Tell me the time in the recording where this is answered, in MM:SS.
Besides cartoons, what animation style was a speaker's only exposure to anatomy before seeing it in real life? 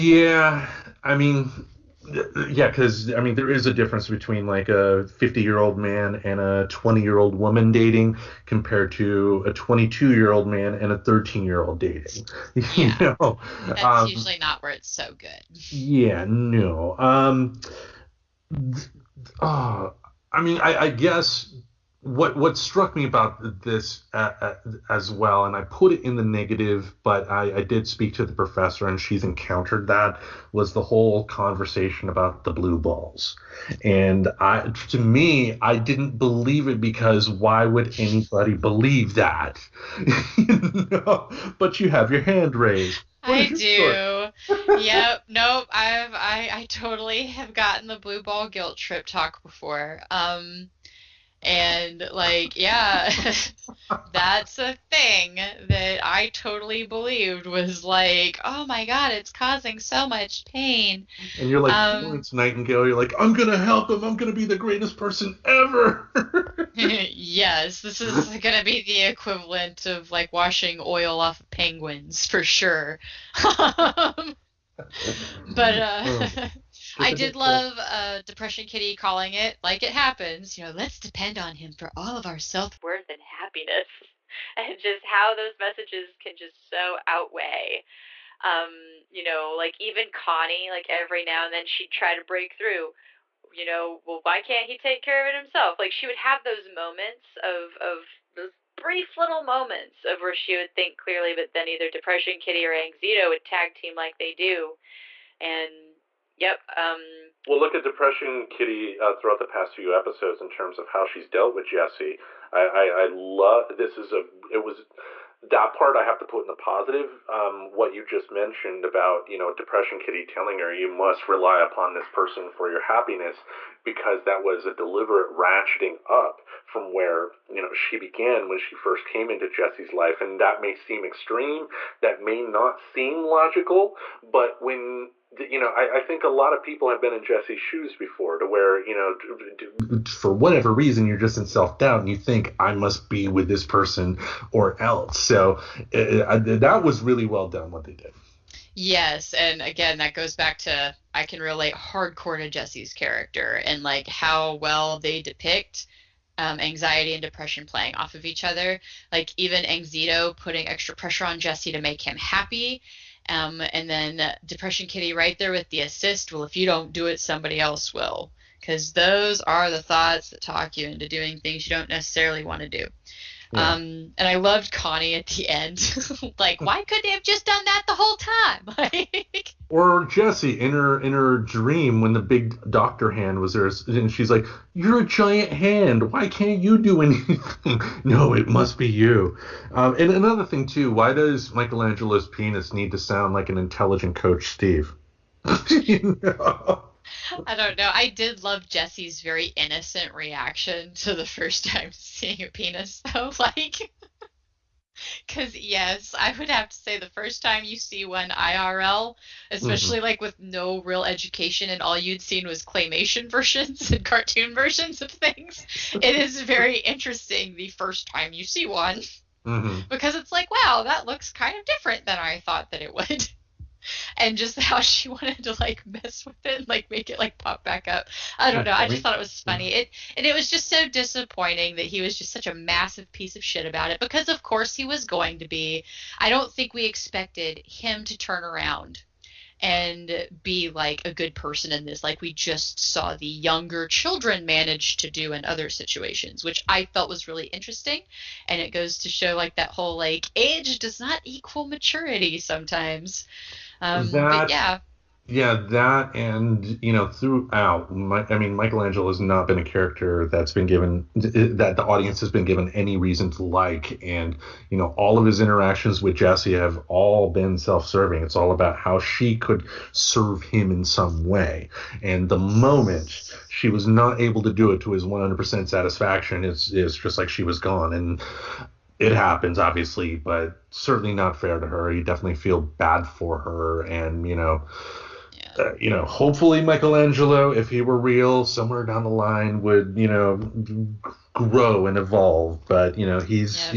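03:32.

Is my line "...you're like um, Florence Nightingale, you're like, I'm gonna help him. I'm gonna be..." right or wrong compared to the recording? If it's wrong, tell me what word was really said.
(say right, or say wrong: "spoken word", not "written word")
right.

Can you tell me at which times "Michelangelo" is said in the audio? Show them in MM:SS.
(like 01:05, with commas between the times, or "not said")
03:11, 04:18, 04:46.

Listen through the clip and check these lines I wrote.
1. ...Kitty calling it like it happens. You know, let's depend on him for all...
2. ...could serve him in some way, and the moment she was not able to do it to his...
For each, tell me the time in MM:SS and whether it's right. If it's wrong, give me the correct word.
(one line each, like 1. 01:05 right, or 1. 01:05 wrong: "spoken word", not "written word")
1. 01:18 right
2. 04:29 right.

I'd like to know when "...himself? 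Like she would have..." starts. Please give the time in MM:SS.
01:35.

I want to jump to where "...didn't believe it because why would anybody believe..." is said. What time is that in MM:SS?
00:35.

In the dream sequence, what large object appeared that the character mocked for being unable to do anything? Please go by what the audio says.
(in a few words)
a giant hand.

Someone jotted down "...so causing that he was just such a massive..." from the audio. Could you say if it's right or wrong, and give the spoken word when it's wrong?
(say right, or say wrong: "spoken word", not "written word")
wrong: "disappointing", not "causing".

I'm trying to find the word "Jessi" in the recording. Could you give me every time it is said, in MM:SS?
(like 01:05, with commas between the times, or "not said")
01:51, 02:09, 02:17, 02:32, 02:41, 03:00, 03:18, 04:26.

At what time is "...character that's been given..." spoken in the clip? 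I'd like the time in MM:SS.
04:19.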